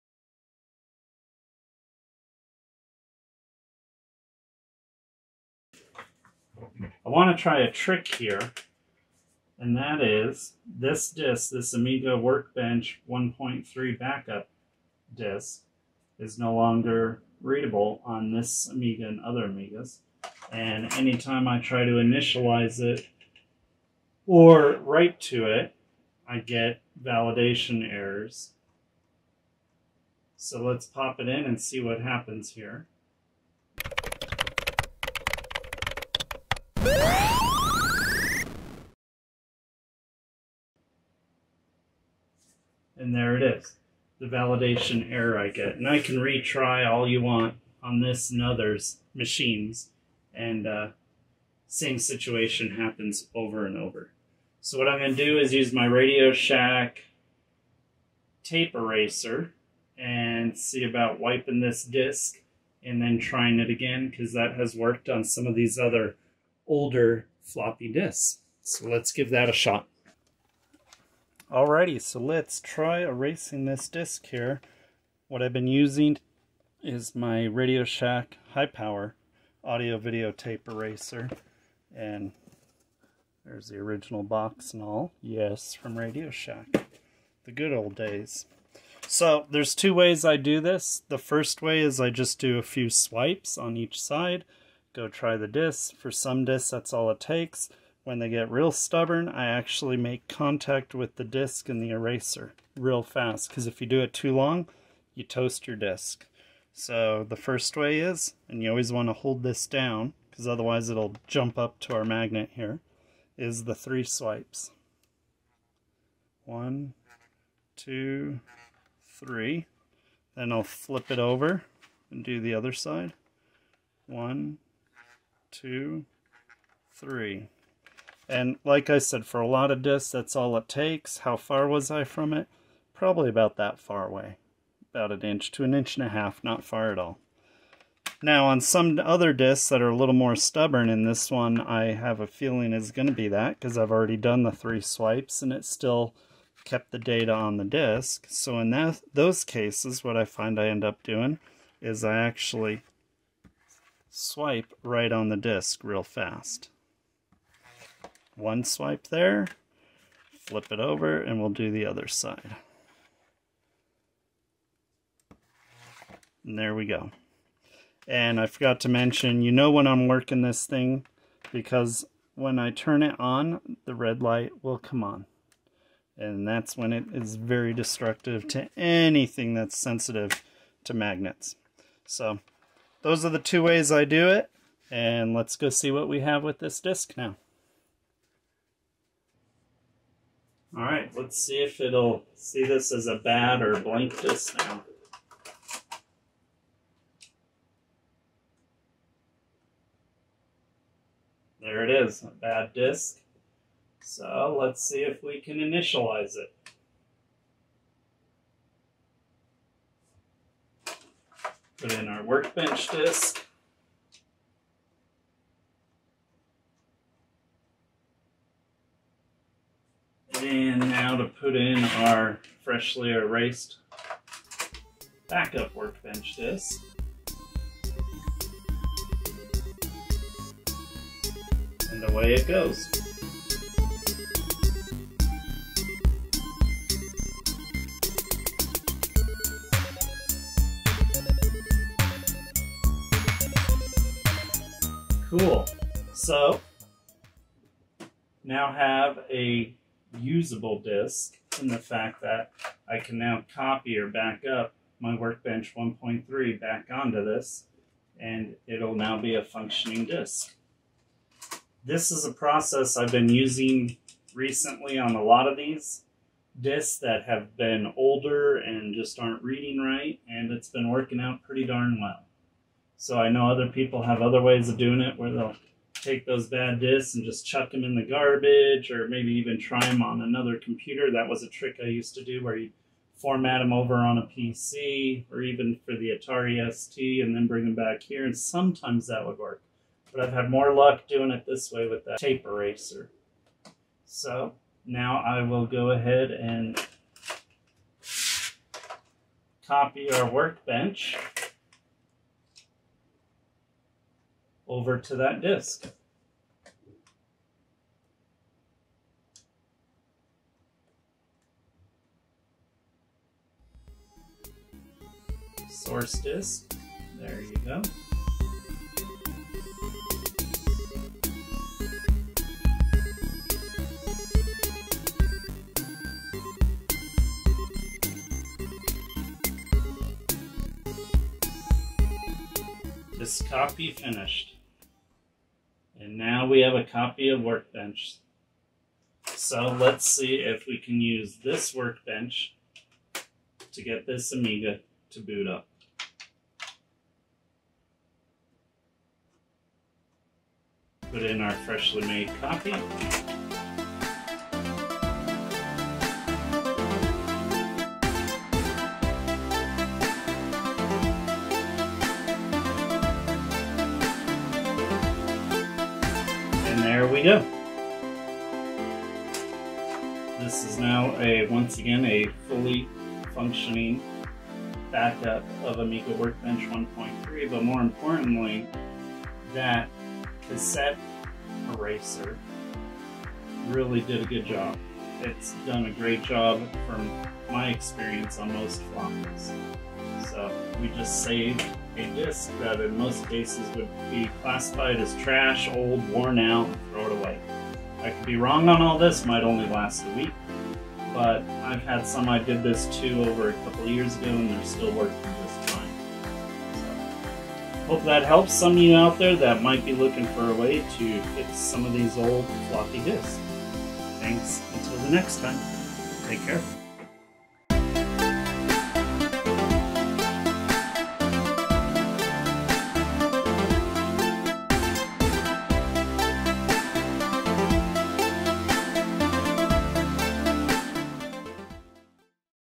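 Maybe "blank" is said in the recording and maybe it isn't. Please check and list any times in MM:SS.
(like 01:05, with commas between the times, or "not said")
03:13.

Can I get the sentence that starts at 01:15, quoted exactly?
What I've been using is my Radio Shack High Power audio video tape eraser.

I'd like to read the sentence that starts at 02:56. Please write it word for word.
And that's when it is very destructive to anything that's sensitive to magnets.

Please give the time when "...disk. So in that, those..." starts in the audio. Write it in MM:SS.
02:27.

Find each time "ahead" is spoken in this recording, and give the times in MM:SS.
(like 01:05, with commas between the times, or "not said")
04:55.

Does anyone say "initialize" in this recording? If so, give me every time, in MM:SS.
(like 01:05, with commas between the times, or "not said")
00:21, 03:25.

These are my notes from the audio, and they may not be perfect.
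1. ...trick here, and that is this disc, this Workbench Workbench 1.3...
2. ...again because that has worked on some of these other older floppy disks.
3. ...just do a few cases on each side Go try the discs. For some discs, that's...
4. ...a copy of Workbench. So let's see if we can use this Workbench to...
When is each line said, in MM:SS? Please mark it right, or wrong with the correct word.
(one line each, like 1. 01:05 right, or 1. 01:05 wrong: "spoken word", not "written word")
1. 00:07 wrong: "Amiga", not "Workbench"
2. 01:03 right
3. 01:32 wrong: "swipes", not "cases"
4. 05:36 right.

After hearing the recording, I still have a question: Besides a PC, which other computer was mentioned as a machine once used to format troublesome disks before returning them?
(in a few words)
Atari ST.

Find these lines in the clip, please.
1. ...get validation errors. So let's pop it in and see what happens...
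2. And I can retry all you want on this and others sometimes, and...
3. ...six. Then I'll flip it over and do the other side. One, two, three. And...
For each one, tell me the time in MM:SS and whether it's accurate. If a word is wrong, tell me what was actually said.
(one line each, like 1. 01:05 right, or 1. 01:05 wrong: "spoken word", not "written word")
1. 00:26 right
2. 00:45 wrong: "machines", not "sometimes"
3. 01:59 wrong: "three", not "six".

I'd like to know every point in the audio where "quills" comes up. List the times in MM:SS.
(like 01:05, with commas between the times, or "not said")
not said.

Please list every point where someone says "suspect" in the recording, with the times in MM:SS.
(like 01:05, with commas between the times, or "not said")
not said.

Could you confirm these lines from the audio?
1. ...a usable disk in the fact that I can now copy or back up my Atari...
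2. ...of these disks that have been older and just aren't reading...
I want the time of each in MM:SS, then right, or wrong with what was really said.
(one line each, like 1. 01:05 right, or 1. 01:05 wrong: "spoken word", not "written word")
1. 04:09 wrong: "Workbench", not "Atari"
2. 04:25 right.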